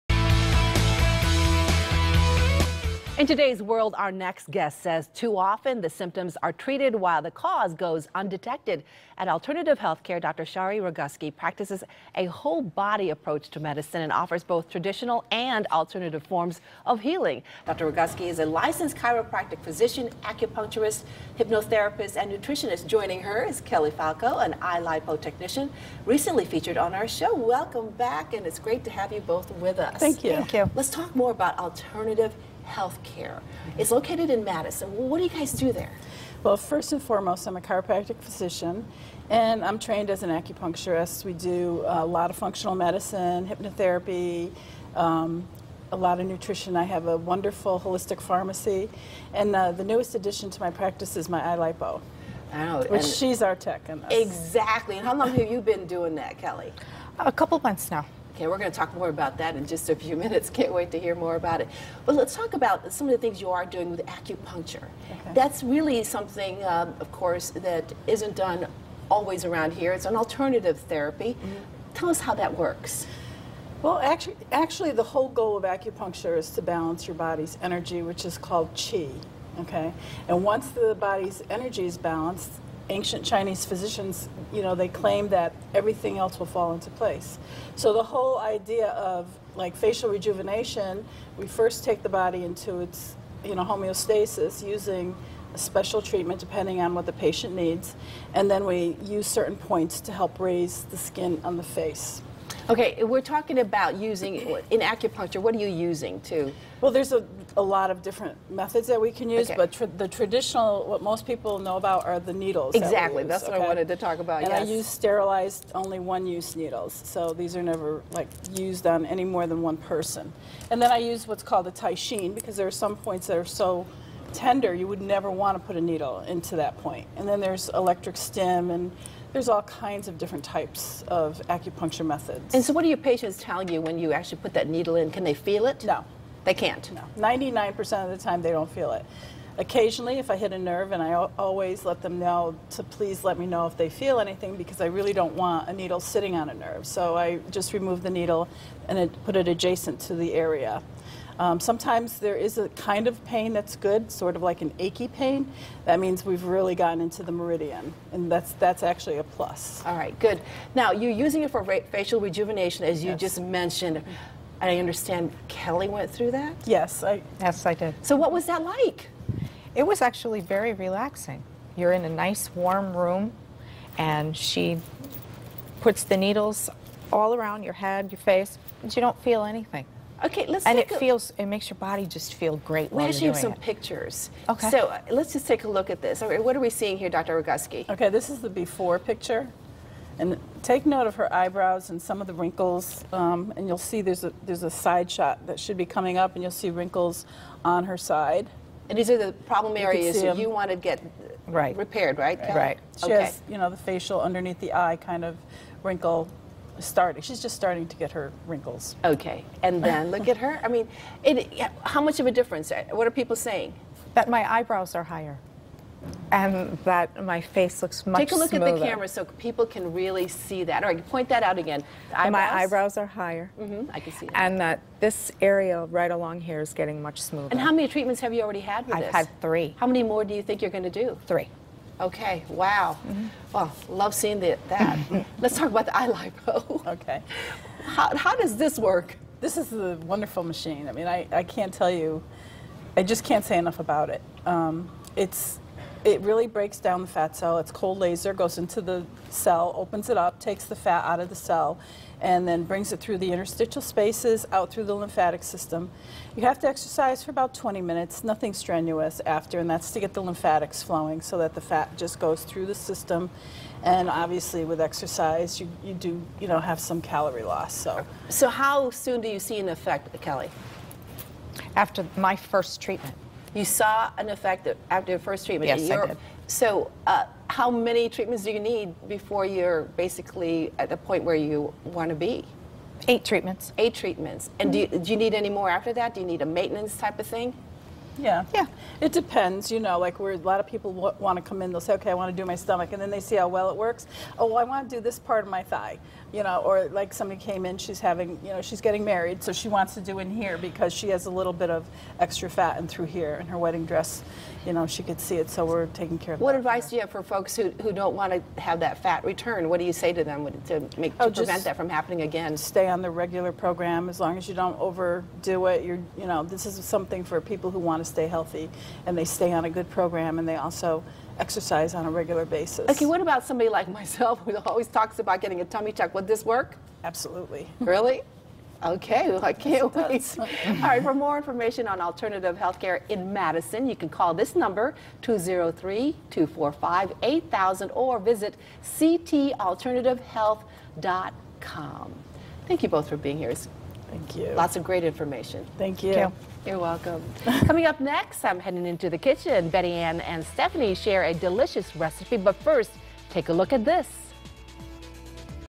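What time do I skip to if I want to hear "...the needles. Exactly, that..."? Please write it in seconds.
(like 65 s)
112 s.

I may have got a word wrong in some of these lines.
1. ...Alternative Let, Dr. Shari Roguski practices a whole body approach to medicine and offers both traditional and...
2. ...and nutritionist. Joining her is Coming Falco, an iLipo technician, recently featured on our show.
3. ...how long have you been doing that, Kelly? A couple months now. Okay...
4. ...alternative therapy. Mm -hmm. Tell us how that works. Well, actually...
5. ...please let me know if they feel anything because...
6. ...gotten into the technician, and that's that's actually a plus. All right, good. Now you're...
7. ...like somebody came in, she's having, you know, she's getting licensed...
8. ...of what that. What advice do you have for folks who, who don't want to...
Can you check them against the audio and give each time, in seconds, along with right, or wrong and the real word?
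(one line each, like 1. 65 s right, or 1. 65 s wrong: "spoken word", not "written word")
1. 9 s wrong: "Healthcare", not "Let"
2. 22 s wrong: "Kelly", not "Coming"
3. 55 s right
4. 70 s right
5. 142 s right
6. 156 s wrong: "meridian", not "technician"
7. 296 s wrong: "married", not "licensed"
8. 306 s right.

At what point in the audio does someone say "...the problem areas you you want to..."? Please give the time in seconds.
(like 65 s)
199 s.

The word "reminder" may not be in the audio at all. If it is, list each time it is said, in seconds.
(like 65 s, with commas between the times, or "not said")
not said.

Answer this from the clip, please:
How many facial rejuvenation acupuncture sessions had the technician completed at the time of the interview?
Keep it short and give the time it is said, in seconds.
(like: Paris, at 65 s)
3, at 229 s.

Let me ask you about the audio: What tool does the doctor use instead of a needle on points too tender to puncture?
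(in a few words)
teishin.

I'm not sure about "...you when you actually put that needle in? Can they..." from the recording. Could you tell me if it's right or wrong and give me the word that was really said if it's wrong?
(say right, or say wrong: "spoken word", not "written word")
right.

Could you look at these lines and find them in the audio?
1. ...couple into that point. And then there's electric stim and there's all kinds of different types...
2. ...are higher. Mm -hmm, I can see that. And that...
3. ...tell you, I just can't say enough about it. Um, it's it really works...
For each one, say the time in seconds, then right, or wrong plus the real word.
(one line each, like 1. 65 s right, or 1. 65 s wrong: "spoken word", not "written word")
1. 125 s wrong: "needle", not "couple"
2. 222 s right
3. 241 s wrong: "breaks", not "works".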